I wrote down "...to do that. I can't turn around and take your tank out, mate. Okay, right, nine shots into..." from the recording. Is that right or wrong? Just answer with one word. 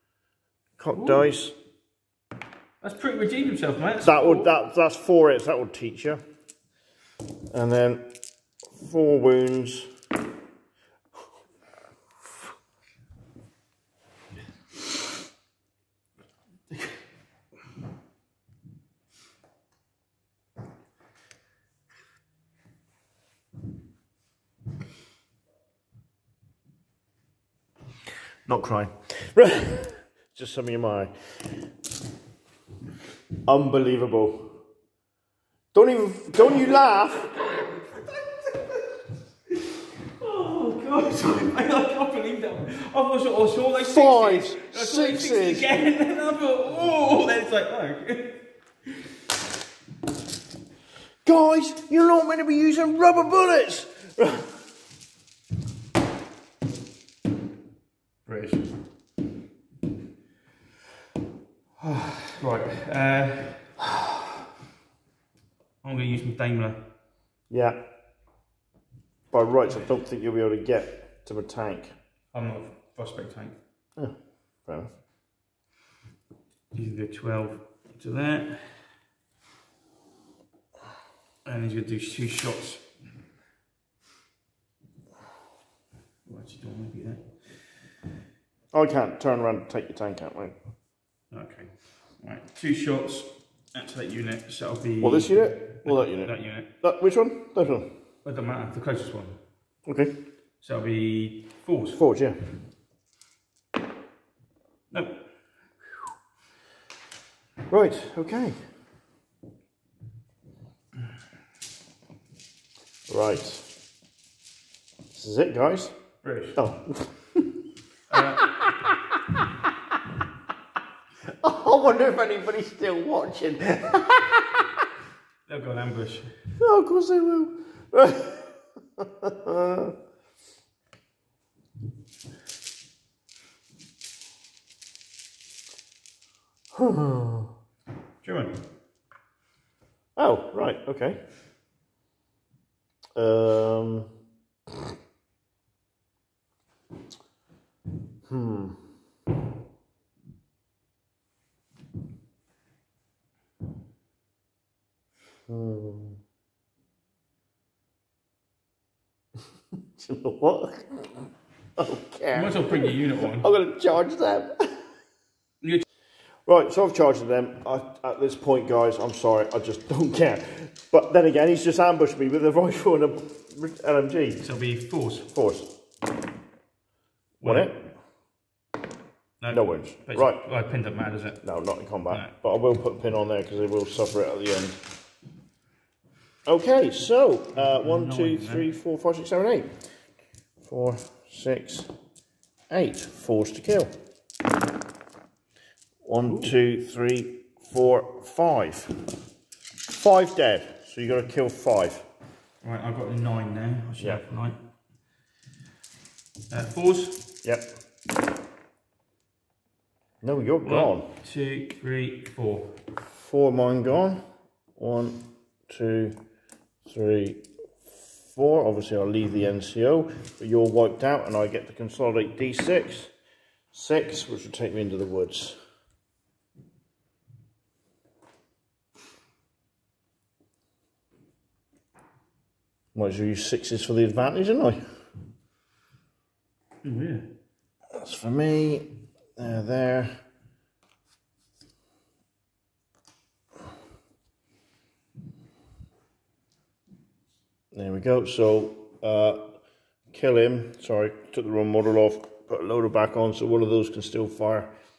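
wrong.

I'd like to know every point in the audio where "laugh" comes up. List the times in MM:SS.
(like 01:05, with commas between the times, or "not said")
00:36.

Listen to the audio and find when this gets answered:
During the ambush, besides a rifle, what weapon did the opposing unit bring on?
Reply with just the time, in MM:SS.
02:53.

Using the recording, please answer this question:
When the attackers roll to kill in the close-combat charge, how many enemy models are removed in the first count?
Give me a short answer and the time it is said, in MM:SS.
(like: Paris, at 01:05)
5, at 03:19.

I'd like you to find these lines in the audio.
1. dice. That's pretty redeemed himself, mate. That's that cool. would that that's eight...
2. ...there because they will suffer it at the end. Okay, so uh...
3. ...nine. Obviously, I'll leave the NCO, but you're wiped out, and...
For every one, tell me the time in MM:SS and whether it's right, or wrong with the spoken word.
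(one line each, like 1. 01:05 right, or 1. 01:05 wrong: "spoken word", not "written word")
1. 00:01 wrong: "four", not "eight"
2. 03:03 right
3. 03:38 wrong: "four", not "nine".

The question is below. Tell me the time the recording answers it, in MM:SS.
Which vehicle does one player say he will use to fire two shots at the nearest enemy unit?
01:06.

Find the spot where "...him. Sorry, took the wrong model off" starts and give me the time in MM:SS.
04:10.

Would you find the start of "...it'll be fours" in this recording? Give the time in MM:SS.
01:40.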